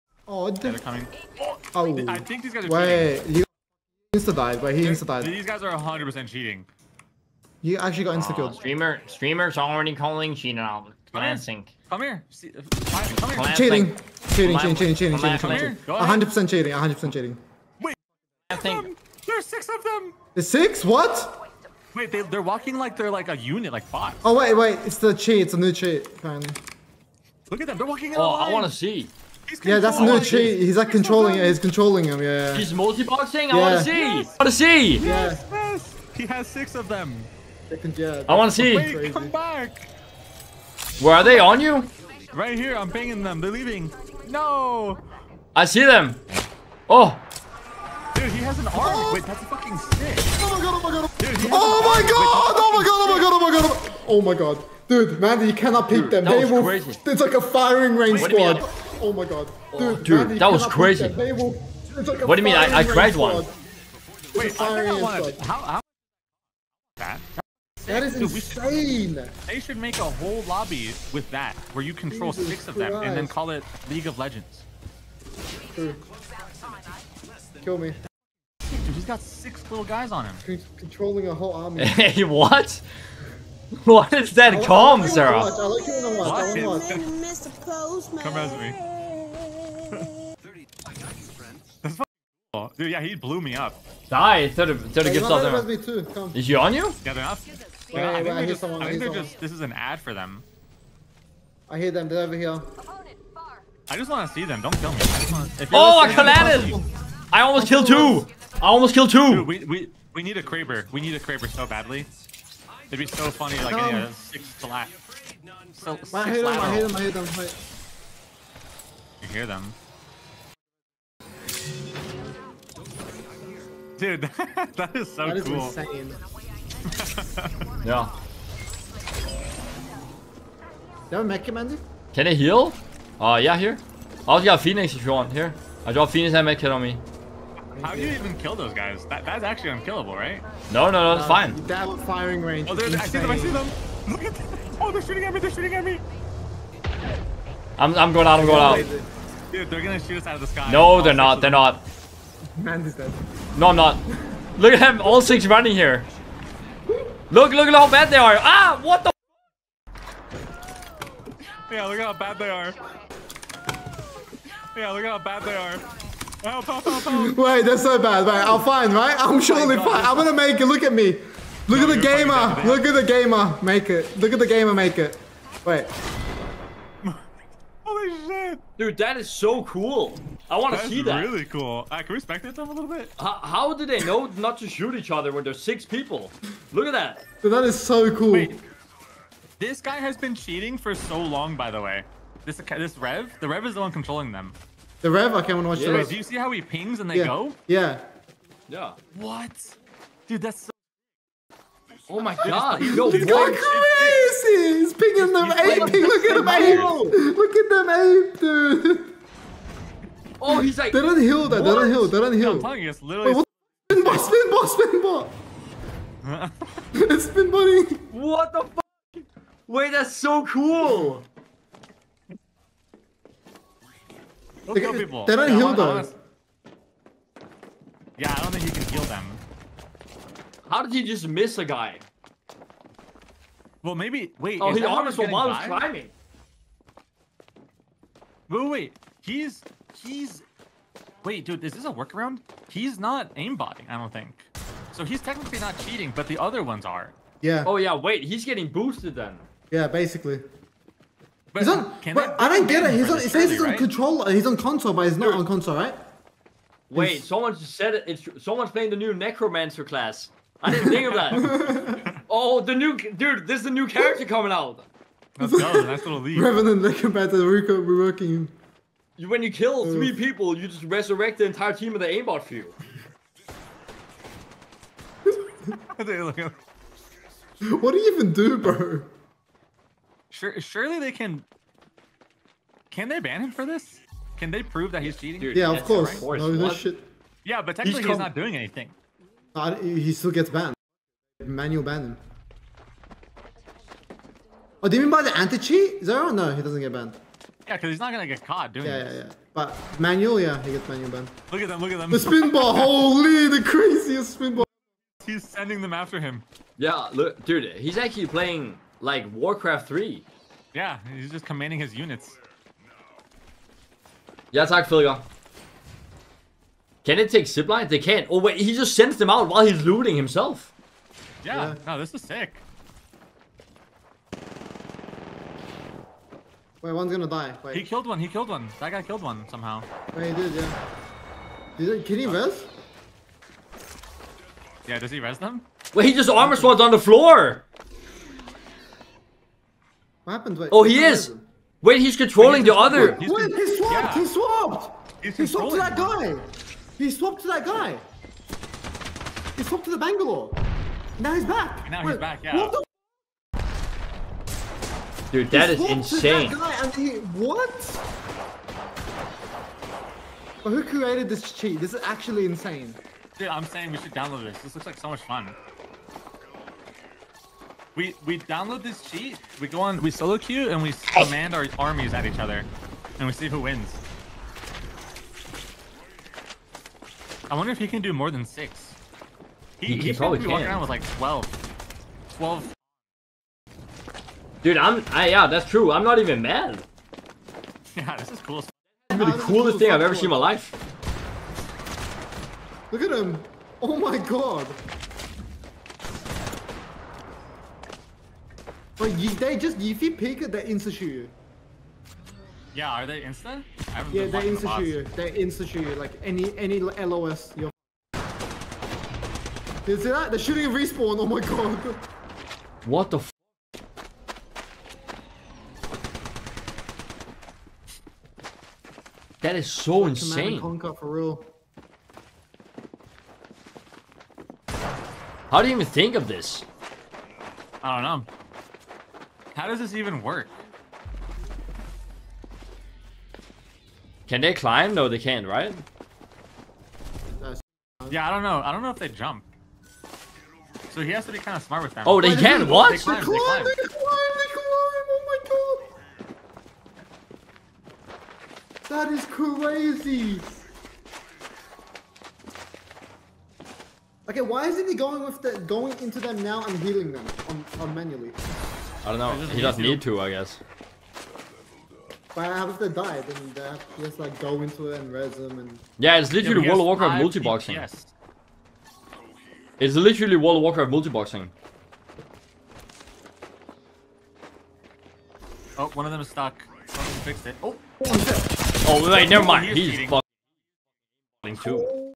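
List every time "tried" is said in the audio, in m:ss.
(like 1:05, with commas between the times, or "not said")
1:02.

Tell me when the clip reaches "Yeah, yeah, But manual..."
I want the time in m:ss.
4:59.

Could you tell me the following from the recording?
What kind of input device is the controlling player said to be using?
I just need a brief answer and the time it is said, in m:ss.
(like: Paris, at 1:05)
controller, at 4:13.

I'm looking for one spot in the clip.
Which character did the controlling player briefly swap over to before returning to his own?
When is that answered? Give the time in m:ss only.
5:49.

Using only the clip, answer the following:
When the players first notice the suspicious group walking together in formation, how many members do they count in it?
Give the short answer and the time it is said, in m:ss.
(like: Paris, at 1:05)
6, at 0:19.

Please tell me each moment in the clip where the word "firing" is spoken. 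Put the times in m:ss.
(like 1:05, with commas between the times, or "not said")
0:57, 2:21.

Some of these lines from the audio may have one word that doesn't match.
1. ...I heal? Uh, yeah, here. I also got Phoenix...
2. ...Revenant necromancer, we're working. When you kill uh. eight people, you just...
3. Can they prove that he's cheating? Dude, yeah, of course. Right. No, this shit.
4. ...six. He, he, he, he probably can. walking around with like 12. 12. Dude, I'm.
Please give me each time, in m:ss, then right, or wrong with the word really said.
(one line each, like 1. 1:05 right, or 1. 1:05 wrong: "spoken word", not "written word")
1. 2:12 right
2. 4:26 wrong: "three", not "eight"
3. 4:44 right
4. 6:18 right.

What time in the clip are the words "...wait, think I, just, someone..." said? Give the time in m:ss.
1:38.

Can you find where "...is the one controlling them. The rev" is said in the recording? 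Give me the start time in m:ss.
3:13.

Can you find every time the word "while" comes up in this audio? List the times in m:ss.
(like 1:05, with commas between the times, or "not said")
3:55, 5:19.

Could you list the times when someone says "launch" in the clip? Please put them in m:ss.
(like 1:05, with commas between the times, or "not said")
not said.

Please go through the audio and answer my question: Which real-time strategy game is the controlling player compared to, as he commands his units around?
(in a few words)
Warcraft 3.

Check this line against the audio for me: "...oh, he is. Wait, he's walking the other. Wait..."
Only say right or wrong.
wrong.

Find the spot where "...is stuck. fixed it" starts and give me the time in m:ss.
7:56.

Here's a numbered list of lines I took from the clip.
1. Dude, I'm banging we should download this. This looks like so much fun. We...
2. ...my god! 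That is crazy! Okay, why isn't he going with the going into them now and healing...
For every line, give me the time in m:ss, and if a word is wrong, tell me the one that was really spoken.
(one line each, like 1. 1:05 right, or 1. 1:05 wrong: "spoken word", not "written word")
1. 6:03 wrong: "saying", not "banging"
2. 7:25 right.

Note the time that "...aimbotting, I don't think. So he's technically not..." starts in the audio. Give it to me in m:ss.
4:03.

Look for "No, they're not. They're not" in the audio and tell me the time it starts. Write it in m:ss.
2:30.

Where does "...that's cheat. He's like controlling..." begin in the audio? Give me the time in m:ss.
0:29.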